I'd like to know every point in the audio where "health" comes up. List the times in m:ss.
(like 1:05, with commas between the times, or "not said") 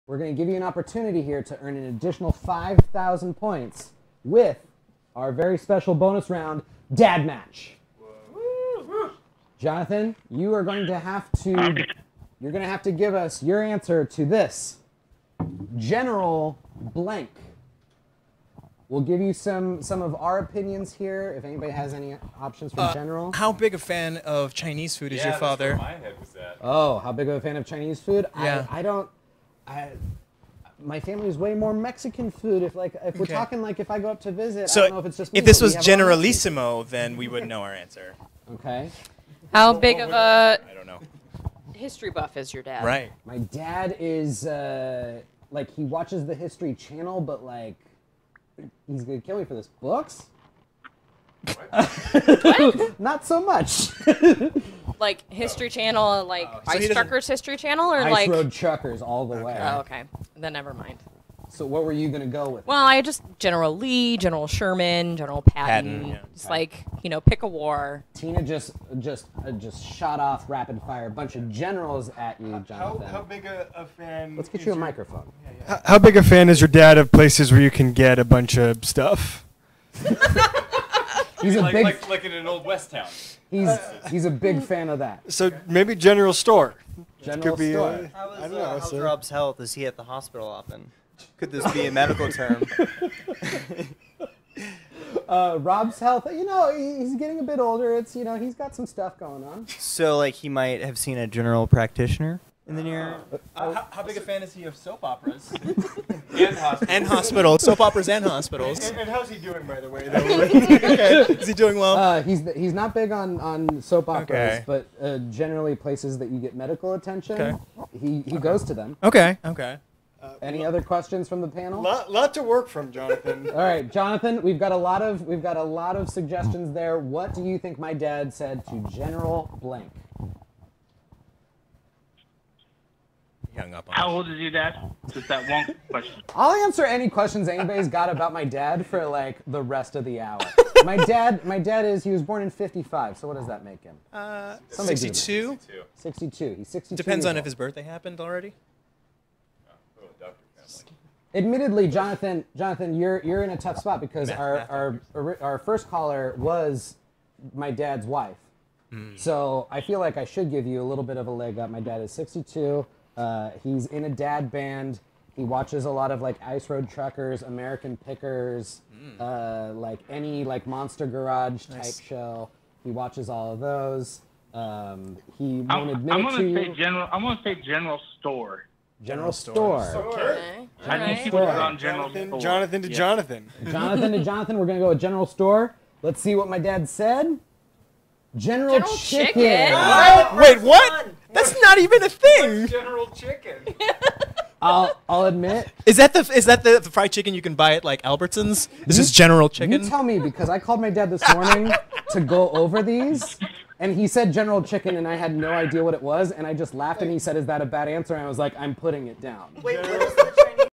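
1:29, 1:35.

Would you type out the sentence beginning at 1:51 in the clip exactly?
Uh, he's he's not big on, on soap operas, okay.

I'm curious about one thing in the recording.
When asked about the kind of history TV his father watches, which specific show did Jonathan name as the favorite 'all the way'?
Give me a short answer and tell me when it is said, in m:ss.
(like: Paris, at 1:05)
Ice Road Truckers, at 0:58.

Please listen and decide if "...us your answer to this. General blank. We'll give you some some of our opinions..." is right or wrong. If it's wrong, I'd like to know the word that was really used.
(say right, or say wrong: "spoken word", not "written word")
right.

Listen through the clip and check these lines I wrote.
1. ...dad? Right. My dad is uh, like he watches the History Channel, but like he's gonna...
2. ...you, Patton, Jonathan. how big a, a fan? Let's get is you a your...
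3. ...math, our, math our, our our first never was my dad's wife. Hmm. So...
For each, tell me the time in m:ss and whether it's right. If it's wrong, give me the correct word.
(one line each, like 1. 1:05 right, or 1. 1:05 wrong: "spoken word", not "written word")
1. 0:42 right
2. 1:12 wrong: "How", not "Patton"
3. 2:34 wrong: "caller", not "never".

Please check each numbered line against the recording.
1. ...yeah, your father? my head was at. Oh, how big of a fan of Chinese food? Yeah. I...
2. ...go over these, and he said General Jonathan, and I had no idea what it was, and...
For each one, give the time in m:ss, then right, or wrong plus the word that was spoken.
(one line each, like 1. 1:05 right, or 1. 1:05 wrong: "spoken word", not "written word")
1. 0:25 right
2. 3:22 wrong: "Chicken", not "Jonathan".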